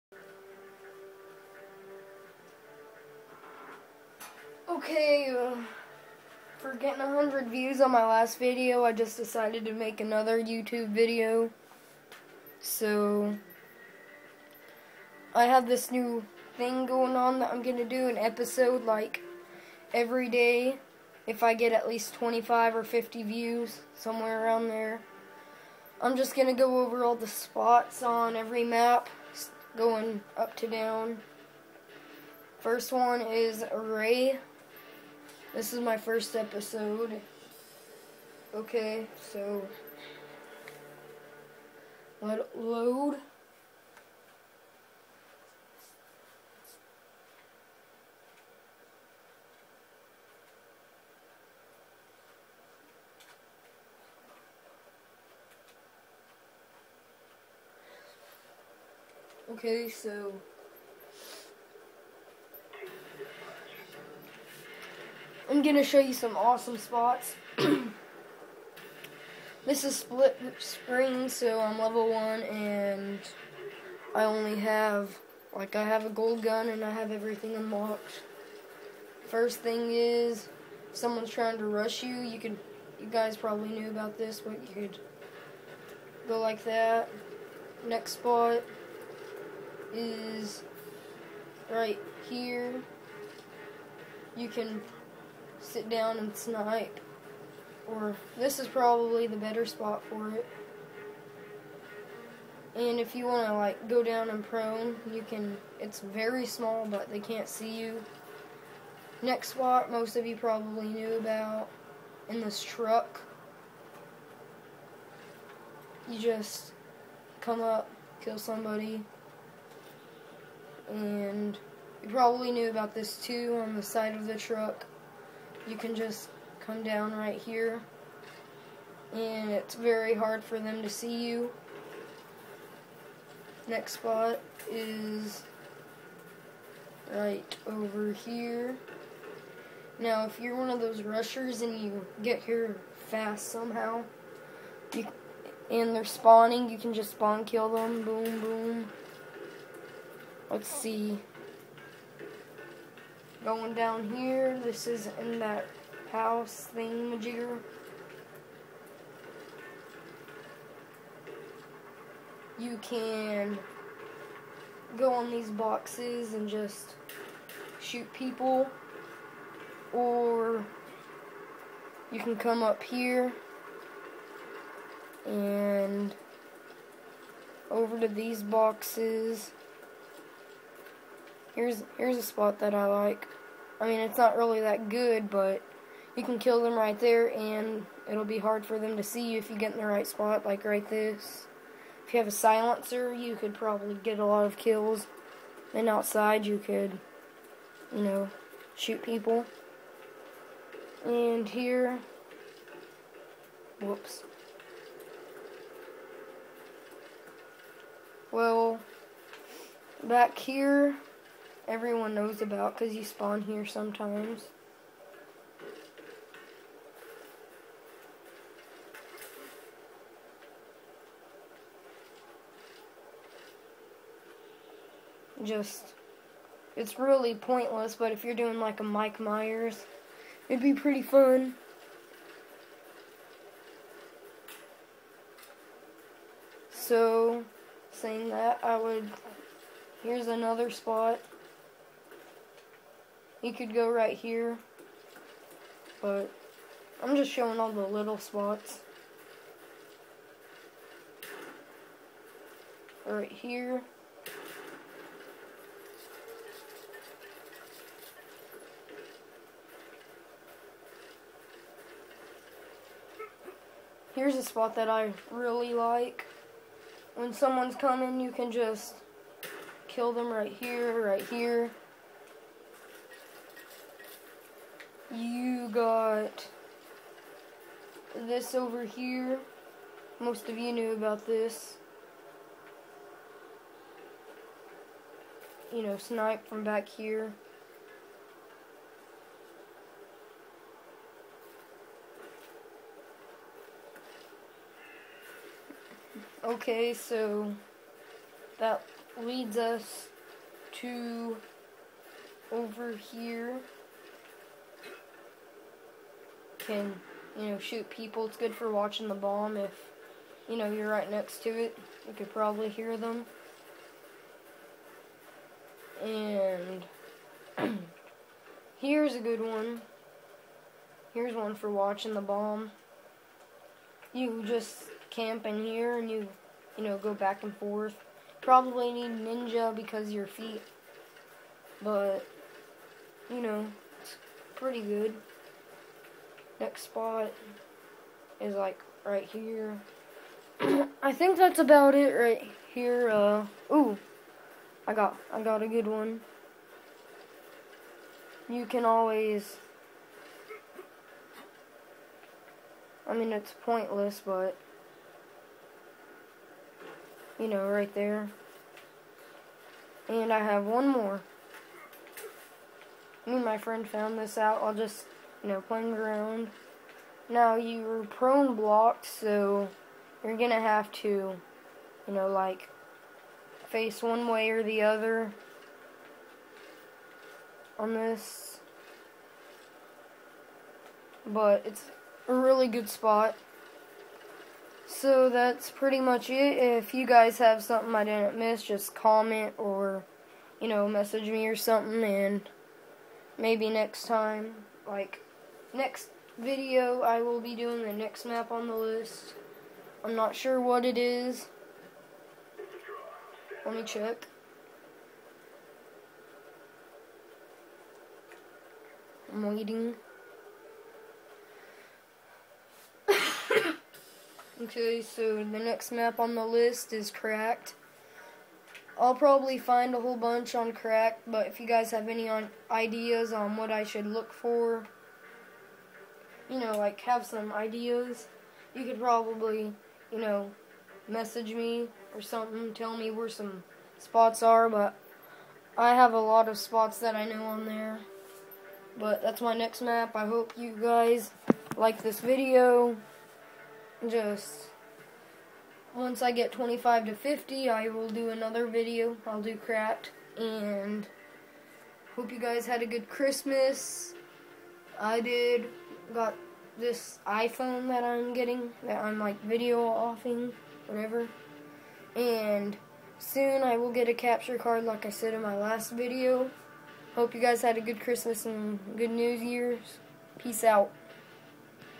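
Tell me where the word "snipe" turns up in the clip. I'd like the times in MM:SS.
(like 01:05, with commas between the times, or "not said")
01:36, 04:45.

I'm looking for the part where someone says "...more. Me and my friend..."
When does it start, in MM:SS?
06:00.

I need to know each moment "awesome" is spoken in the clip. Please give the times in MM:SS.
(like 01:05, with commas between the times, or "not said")
01:06.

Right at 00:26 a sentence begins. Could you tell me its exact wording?
I'm just going to go over all the spots on every map, going up to down.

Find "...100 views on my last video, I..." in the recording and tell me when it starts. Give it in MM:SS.
00:07.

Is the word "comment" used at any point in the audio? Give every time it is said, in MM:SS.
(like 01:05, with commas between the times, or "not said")
06:28.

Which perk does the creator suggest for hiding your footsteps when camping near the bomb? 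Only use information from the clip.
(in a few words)
Ninja.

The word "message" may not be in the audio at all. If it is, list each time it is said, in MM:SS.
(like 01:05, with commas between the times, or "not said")
06:30, 07:11.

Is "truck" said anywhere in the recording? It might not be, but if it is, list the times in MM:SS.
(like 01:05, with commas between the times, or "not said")
01:52, 02:04.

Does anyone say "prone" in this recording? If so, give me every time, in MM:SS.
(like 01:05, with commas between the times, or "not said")
01:44, 06:08.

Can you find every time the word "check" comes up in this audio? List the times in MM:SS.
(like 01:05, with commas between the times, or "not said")
06:43.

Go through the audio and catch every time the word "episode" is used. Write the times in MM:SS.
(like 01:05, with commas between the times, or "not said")
00:18, 00:36.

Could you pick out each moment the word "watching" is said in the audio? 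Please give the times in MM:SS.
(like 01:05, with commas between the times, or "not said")
05:08, 05:21.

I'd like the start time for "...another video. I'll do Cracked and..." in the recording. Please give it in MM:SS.
07:28.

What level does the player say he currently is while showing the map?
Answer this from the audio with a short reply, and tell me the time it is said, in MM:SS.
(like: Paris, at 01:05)
1, at 01:11.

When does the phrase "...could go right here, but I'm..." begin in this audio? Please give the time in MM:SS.
04:03.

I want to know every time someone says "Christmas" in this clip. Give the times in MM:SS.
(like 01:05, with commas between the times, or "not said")
07:33, 07:47.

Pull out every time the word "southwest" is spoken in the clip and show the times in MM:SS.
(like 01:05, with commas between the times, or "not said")
not said.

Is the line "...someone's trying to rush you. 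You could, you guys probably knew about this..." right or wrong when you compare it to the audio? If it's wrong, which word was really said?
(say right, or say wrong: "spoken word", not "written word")
right.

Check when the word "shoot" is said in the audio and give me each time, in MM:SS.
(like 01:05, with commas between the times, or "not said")
02:47, 03:18, 05:07.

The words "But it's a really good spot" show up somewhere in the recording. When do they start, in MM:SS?
06:21.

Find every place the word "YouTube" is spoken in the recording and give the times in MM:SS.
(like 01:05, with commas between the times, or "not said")
00:10.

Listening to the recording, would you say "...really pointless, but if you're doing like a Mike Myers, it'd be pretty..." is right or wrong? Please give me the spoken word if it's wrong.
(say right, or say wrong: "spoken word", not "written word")
right.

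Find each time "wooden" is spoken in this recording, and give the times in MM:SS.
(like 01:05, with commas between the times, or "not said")
not said.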